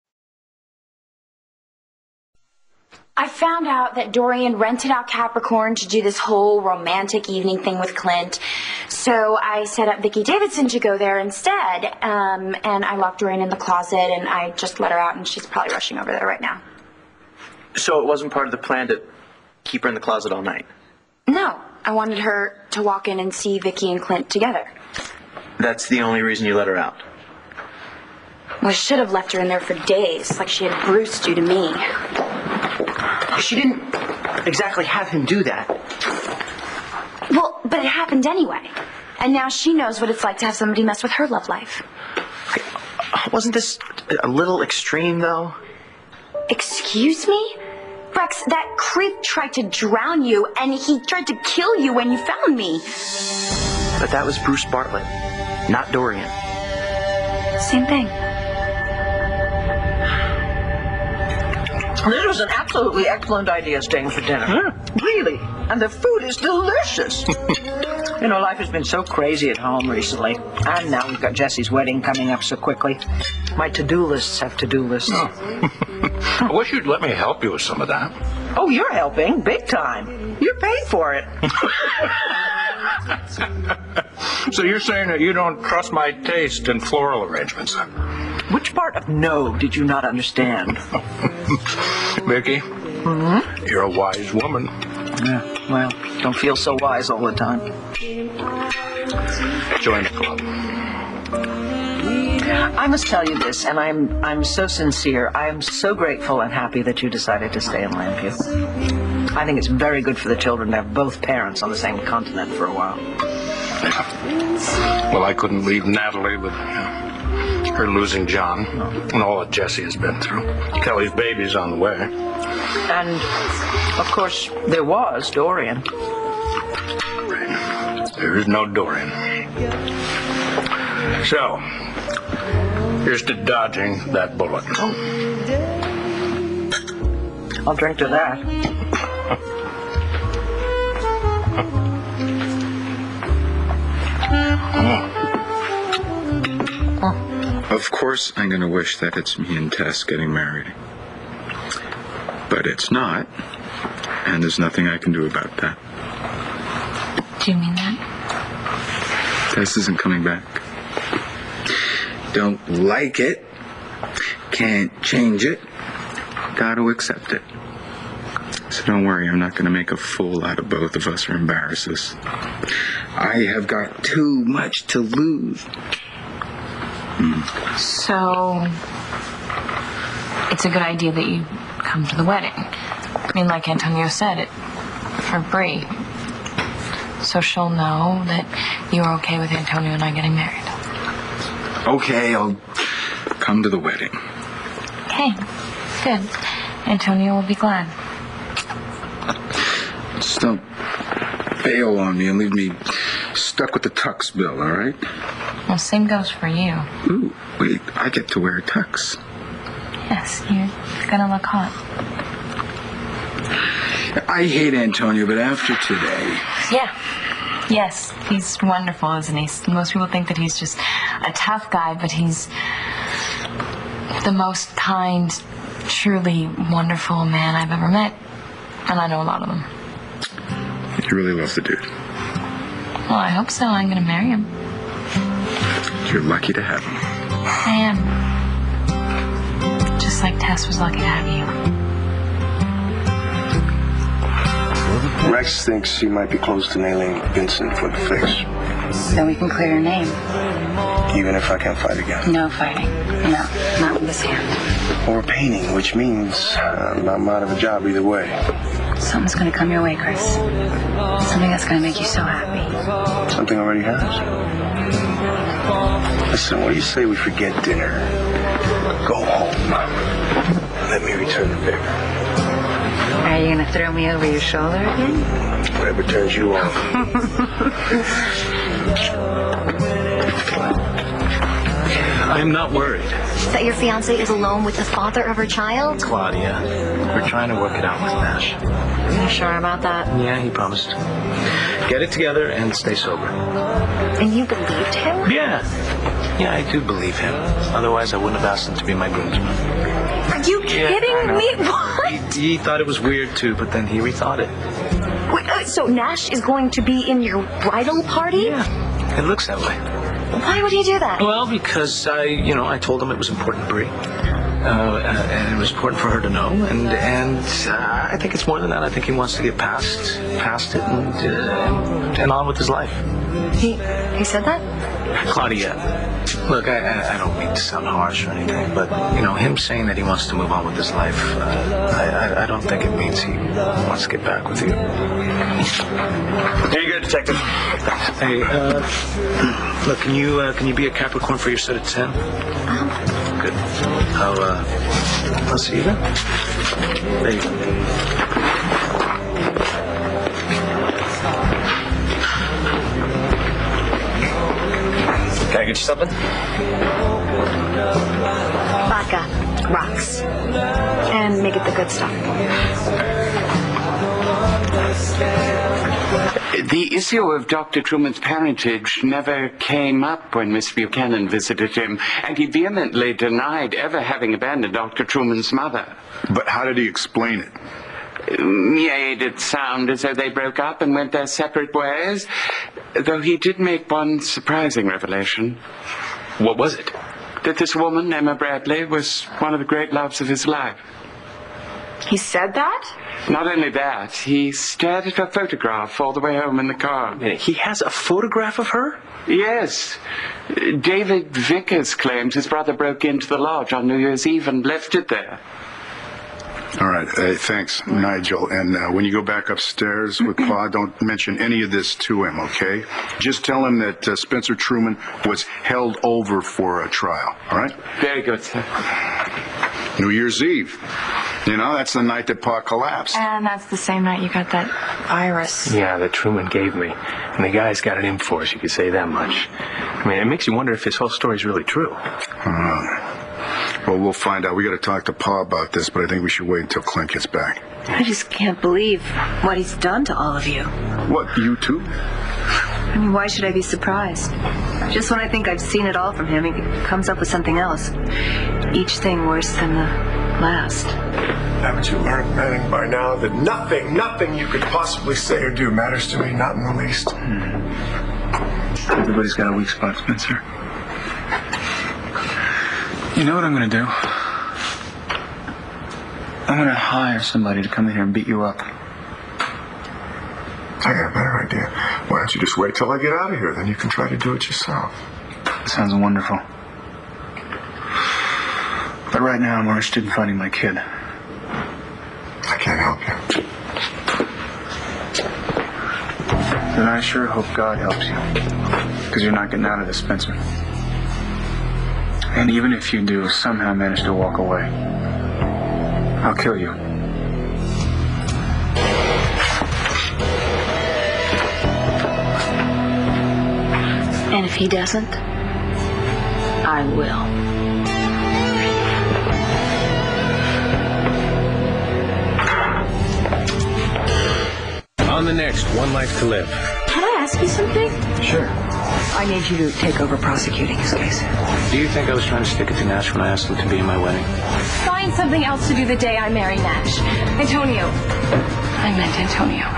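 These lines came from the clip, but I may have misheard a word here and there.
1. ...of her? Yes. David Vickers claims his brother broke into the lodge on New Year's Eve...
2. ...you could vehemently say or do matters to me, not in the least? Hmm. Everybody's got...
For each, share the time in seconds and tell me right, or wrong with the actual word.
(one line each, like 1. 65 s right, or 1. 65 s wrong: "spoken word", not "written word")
1. 398 s right
2. 454 s wrong: "possibly", not "vehemently".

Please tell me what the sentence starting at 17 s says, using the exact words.
So it wasn't part of the plan to keep her in the closet all night?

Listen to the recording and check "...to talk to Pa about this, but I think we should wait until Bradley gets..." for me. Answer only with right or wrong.
wrong.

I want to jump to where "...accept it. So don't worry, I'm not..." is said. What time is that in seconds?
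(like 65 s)
166 s.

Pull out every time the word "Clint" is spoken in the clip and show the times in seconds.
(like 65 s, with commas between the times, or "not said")
7 s, 24 s, 436 s.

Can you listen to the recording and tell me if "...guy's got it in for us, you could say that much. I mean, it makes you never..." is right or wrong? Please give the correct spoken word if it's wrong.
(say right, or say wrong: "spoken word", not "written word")
wrong: "wonder", not "never".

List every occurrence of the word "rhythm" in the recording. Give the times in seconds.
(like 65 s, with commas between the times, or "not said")
not said.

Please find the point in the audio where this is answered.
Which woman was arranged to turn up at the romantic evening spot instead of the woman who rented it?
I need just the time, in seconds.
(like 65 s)
9 s.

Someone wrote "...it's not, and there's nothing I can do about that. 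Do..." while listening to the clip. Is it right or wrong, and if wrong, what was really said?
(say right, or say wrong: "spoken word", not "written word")
right.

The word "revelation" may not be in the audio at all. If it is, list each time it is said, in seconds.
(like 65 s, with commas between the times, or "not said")
384 s.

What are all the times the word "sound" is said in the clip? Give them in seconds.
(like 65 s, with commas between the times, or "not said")
327 s, 379 s, 475 s.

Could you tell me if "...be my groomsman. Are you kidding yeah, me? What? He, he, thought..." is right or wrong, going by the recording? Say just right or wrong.
right.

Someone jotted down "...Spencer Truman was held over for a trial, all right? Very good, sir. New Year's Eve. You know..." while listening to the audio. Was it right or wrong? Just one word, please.
right.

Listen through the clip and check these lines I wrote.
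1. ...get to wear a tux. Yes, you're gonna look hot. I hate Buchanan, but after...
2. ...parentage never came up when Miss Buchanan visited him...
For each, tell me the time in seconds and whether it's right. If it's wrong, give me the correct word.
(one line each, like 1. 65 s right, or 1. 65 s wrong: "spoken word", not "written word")
1. 208 s wrong: "Antonio", not "Buchanan"
2. 368 s right.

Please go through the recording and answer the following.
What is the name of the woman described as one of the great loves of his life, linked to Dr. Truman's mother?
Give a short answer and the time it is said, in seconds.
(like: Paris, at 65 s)
Emma Bradley, at 388 s.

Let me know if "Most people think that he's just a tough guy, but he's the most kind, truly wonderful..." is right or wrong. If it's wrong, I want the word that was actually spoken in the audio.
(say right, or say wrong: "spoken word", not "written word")
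right.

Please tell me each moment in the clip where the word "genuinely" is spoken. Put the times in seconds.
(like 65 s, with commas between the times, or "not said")
not said.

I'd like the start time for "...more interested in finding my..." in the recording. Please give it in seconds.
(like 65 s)
479 s.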